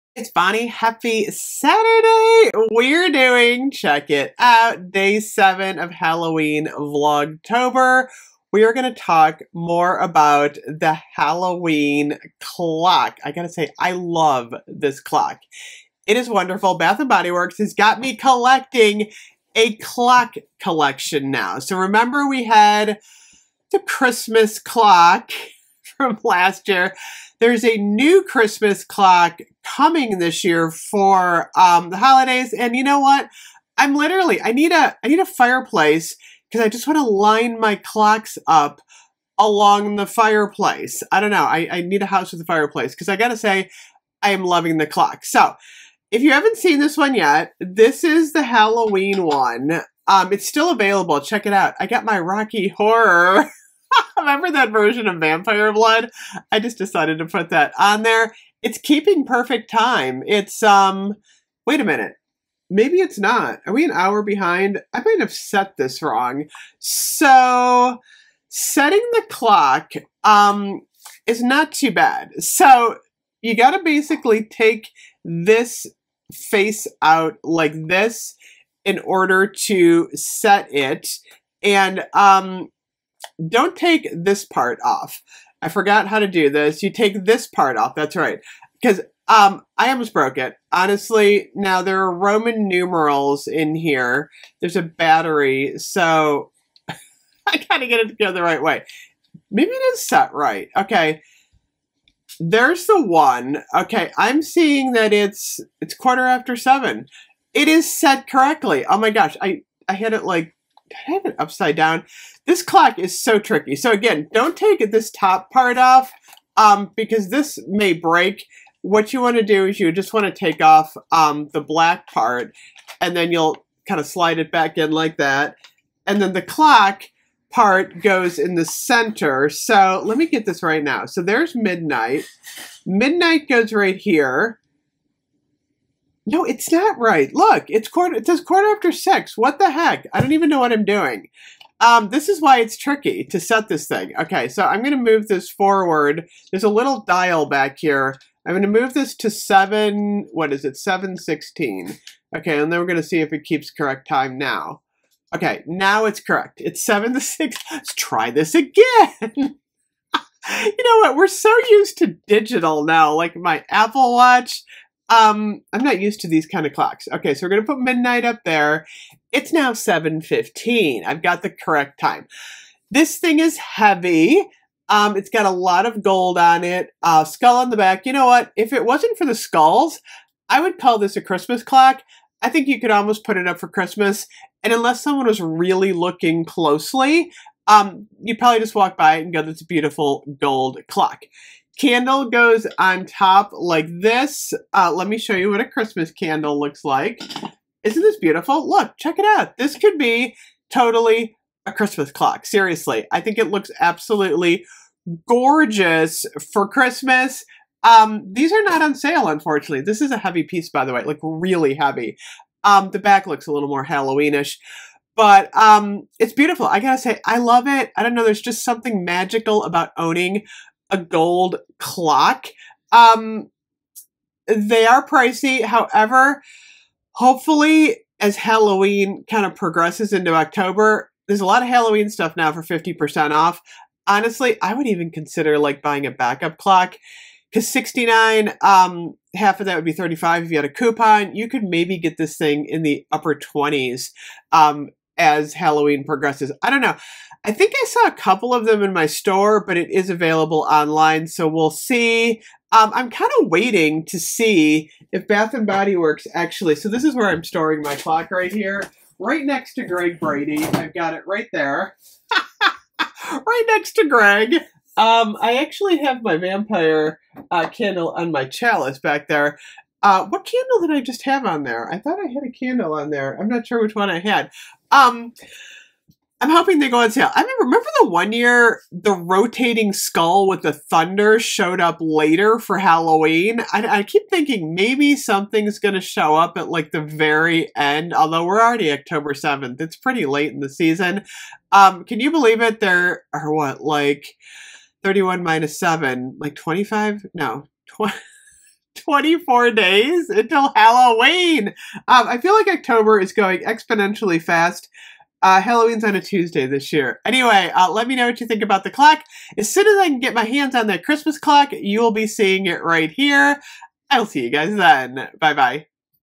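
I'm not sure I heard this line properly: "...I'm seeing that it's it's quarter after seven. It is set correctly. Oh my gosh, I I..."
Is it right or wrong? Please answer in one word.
right.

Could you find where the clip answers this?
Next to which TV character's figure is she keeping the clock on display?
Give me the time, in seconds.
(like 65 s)
259 s.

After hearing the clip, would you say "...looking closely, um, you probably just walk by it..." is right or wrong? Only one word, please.
right.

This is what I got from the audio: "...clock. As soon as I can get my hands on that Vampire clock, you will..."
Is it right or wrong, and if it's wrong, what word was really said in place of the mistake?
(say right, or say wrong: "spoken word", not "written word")
wrong: "Christmas", not "Vampire".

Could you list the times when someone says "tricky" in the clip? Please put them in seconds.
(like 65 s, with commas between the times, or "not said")
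113 s, 142 s.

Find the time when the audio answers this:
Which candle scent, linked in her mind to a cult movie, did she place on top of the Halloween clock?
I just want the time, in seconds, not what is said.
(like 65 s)
55 s.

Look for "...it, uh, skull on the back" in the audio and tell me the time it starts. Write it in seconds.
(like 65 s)
176 s.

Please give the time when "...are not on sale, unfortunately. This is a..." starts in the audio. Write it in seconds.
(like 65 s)
208 s.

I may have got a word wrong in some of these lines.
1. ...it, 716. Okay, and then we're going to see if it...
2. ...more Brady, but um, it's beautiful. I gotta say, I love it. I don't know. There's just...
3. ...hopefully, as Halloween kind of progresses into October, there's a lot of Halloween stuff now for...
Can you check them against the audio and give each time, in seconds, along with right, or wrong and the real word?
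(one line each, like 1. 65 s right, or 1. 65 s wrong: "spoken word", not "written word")
1. 150 s right
2. 213 s wrong: "Halloweenish", not "Brady"
3. 227 s right.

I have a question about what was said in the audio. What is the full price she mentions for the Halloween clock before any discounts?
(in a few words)
69.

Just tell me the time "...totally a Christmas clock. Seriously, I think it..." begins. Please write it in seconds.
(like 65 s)
200 s.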